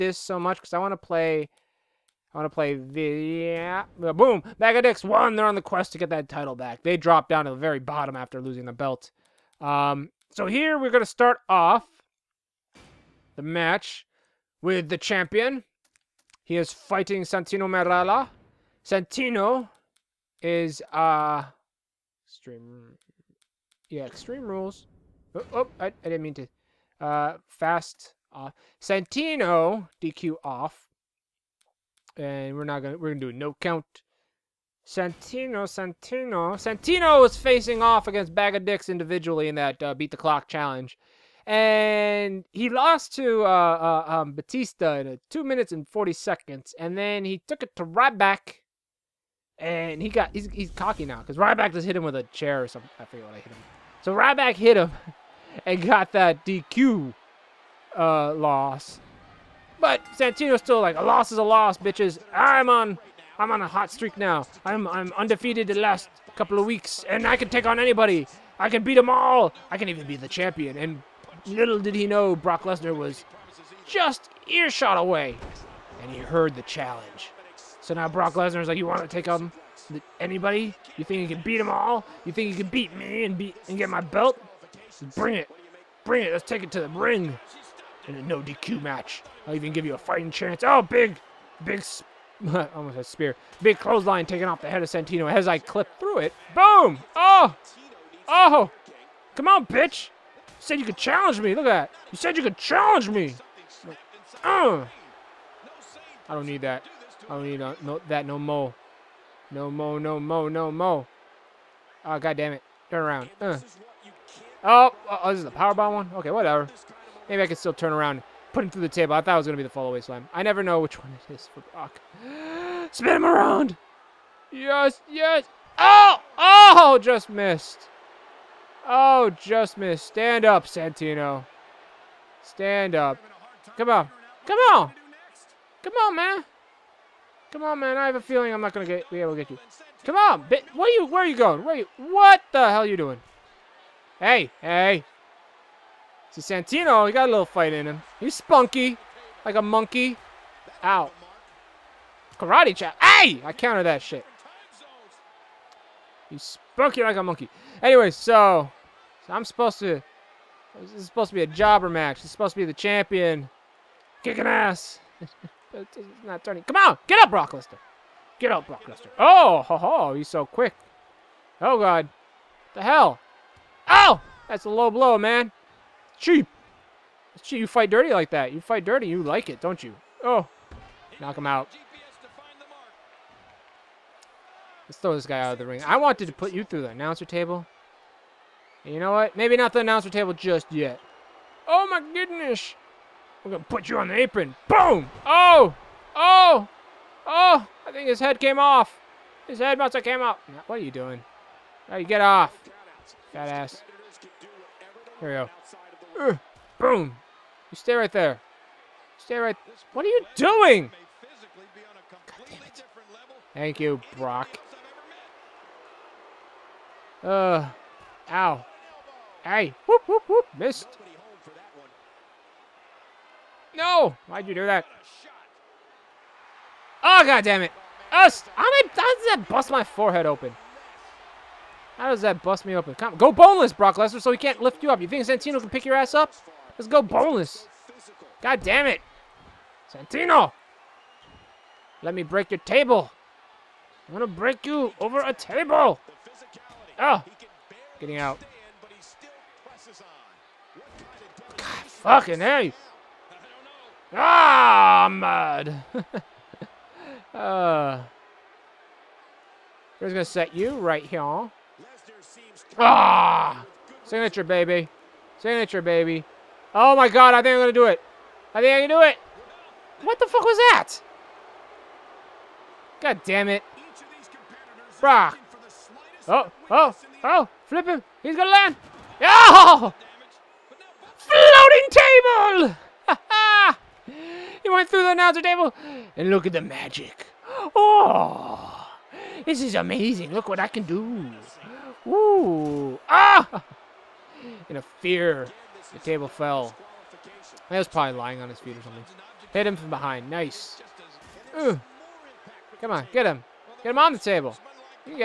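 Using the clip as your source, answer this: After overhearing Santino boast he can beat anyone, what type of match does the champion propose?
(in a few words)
No DQ match.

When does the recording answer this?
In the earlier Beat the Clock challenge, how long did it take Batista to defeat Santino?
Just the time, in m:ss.
0:45.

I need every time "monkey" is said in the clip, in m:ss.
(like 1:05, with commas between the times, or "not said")
2:29, 2:37.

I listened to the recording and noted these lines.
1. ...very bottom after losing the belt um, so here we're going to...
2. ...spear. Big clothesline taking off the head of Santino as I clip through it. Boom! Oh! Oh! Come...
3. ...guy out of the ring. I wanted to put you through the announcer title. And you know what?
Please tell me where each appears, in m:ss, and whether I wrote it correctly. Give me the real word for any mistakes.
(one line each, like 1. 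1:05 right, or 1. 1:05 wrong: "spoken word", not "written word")
1. 0:07 right
2. 1:33 right
3. 3:05 wrong: "table", not "title".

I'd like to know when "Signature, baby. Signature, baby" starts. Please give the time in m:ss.
4:24.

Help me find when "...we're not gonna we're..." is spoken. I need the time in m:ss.
0:32.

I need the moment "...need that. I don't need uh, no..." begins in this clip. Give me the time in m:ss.
1:46.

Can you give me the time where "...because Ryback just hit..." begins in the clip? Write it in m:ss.
0:51.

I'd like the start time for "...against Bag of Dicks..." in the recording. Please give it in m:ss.
0:38.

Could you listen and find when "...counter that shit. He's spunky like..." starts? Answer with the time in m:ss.
2:33.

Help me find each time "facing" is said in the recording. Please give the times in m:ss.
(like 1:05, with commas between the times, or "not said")
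0:37.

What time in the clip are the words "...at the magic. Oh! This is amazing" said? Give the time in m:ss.
4:46.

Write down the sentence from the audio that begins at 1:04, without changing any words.
I'm I'm undefeated the last couple of weeks, and I can take on anybody.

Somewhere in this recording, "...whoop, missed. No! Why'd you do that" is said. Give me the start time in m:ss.
3:40.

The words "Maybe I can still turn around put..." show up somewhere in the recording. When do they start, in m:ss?
1:57.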